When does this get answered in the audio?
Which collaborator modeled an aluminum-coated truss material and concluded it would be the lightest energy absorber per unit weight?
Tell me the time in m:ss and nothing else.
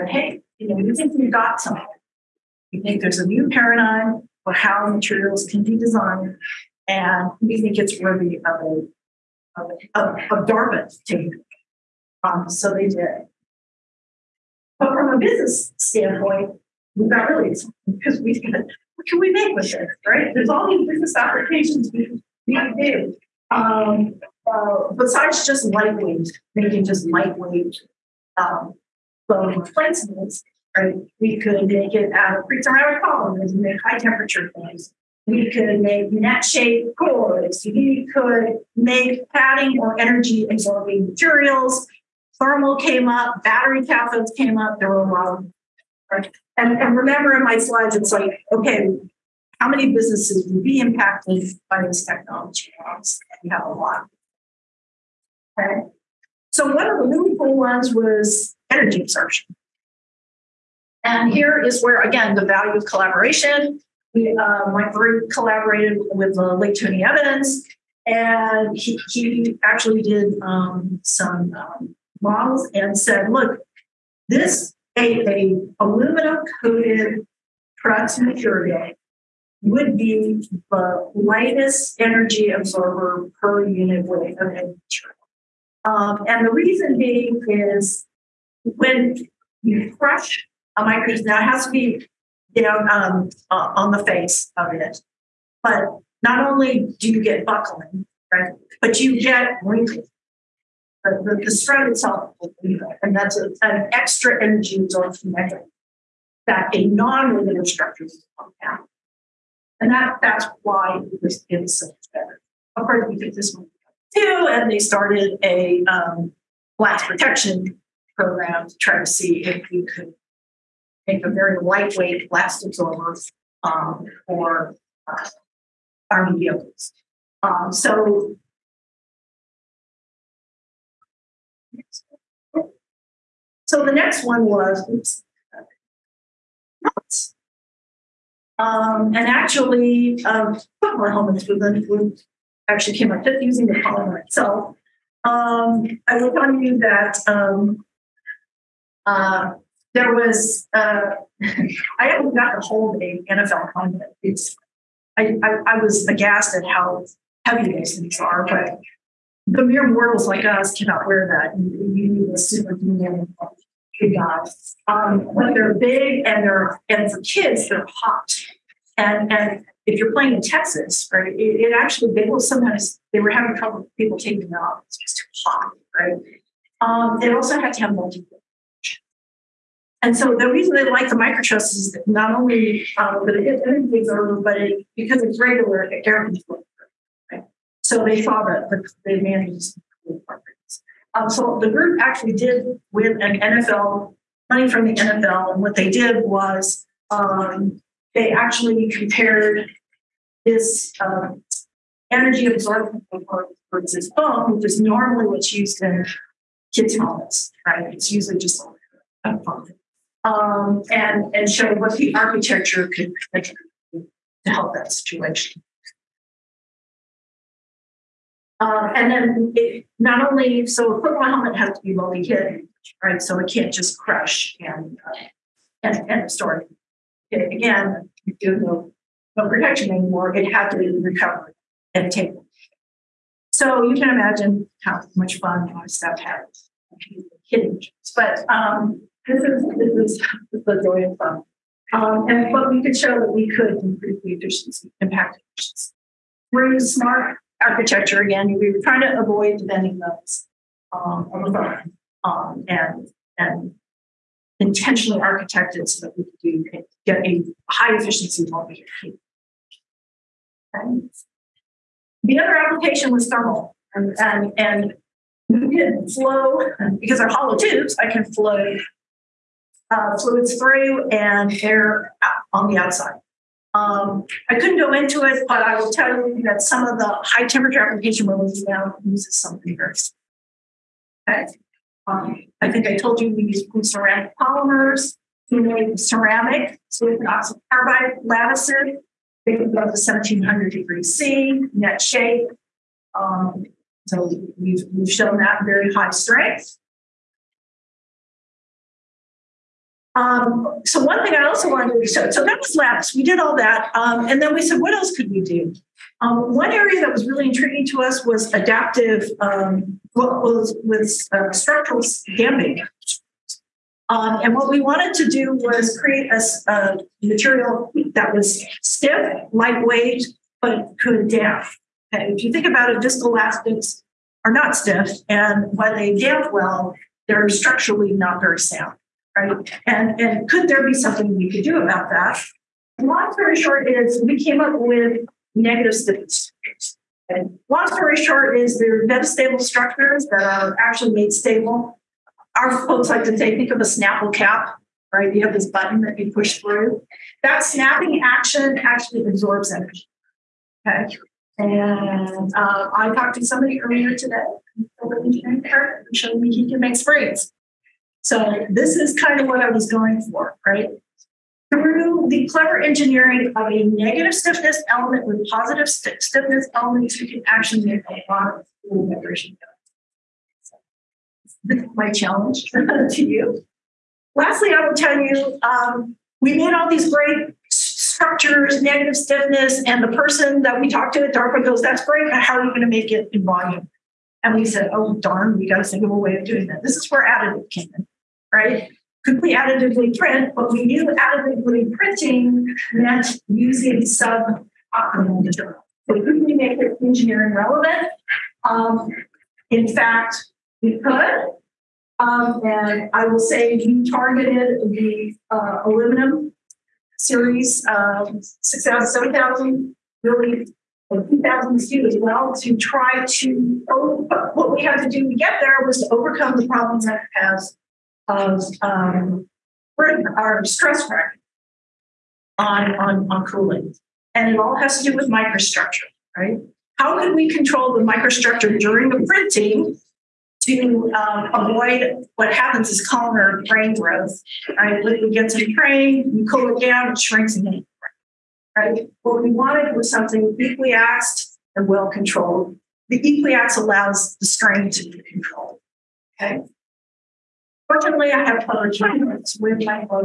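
1:06.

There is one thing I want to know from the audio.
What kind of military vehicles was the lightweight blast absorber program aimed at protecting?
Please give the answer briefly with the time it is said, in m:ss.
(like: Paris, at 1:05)
Army vehicles, at 2:06.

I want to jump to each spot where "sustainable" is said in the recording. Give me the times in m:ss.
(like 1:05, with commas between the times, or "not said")
not said.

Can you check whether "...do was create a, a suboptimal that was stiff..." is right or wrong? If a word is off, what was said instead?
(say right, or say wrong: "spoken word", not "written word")
wrong: "material", not "suboptimal".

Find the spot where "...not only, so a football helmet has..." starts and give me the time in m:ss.
3:39.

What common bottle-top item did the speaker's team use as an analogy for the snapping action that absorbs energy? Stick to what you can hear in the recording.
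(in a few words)
Snapple cap.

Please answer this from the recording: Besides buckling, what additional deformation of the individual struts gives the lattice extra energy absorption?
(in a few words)
Wrinkling.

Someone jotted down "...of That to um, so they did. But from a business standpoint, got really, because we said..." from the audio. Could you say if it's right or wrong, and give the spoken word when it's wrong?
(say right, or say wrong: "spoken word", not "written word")
wrong: "Dartmouth", not "That".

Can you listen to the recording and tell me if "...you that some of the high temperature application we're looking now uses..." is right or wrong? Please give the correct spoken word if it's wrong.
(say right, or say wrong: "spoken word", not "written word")
right.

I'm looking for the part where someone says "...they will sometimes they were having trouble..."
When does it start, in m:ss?
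2:52.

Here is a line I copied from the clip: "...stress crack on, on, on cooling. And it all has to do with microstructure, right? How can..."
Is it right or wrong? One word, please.
right.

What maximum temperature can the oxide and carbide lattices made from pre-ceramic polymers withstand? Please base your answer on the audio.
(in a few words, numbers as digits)
1700 degrees C.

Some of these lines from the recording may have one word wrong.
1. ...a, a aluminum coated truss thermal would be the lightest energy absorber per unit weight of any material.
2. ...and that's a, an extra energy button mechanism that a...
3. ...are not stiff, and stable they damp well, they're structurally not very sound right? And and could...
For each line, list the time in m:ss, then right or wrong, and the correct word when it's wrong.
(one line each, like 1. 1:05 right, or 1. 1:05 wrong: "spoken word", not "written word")
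1. 1:14 wrong: "material", not "thermal"
2. 1:43 wrong: "absorption", not "button"
3. 5:24 wrong: "while", not "stable".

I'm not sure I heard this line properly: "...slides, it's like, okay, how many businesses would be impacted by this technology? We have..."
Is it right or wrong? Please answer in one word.
right.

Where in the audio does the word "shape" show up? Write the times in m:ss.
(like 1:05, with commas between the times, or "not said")
0:36, 4:52.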